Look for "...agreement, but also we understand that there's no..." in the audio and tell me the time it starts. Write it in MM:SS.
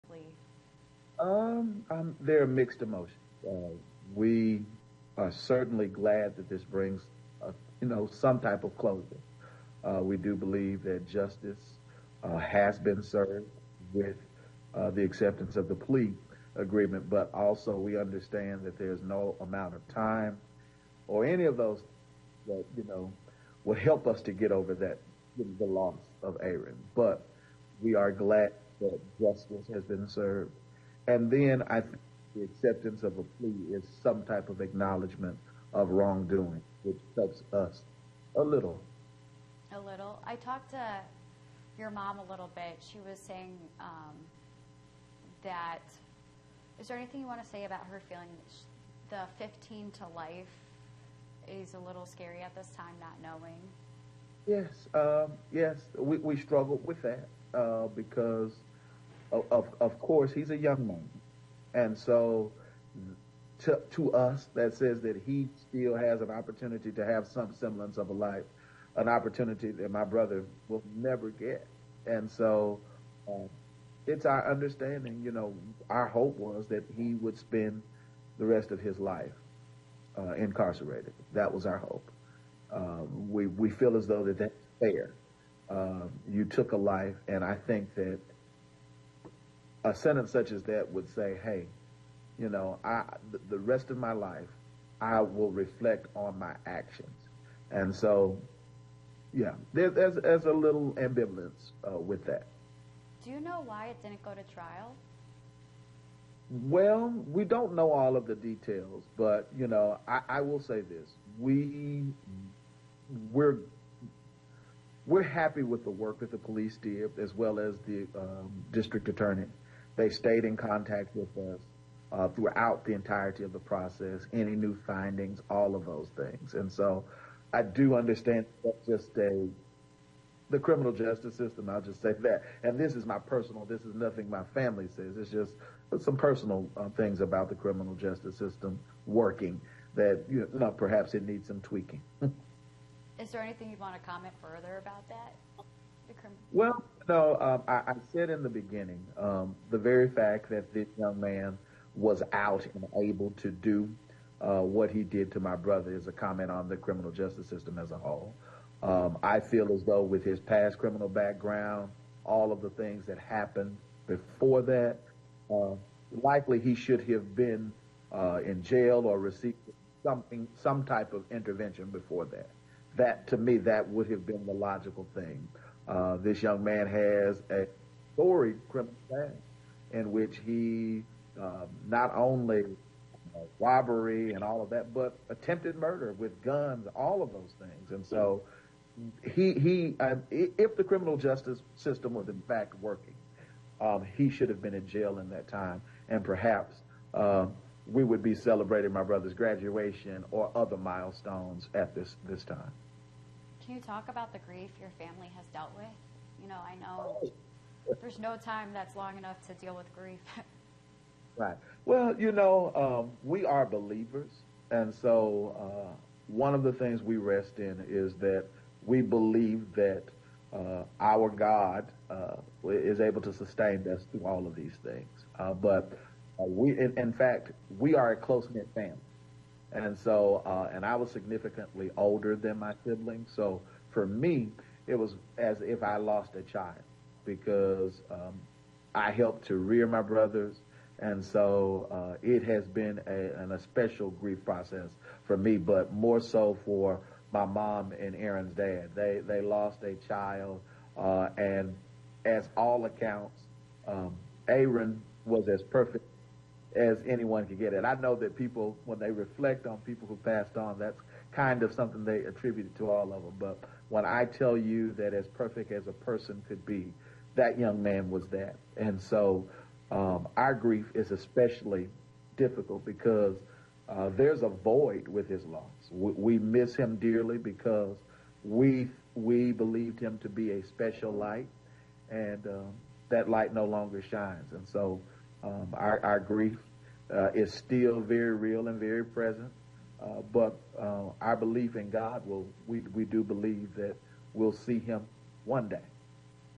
00:16.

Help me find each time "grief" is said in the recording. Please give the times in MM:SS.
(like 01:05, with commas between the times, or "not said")
03:24, 03:29, 04:04, 04:30, 04:46.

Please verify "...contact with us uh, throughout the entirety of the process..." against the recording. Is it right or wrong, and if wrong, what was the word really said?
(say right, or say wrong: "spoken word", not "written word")
right.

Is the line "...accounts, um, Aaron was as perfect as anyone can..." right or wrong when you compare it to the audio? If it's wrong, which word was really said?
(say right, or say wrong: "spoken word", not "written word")
right.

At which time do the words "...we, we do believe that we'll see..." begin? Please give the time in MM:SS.
04:52.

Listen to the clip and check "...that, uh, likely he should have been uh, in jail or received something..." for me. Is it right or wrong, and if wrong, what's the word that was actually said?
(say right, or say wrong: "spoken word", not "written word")
right.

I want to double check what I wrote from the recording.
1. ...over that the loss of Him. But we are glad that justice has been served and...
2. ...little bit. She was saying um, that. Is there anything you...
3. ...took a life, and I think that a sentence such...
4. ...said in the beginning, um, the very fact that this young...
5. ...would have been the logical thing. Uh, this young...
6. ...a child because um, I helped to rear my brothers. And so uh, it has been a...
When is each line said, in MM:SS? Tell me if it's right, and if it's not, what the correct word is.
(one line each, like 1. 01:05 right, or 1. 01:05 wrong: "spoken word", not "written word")
1. 00:24 wrong: "Aaron", not "Him"
2. 00:42 right
3. 01:26 right
4. 02:28 right
5. 02:53 right
6. 03:56 right.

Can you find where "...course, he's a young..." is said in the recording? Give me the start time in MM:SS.
00:59.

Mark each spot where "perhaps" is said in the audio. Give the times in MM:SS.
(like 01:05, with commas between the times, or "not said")
02:20, 03:16.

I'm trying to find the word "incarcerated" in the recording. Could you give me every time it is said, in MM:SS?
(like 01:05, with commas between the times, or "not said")
01:20.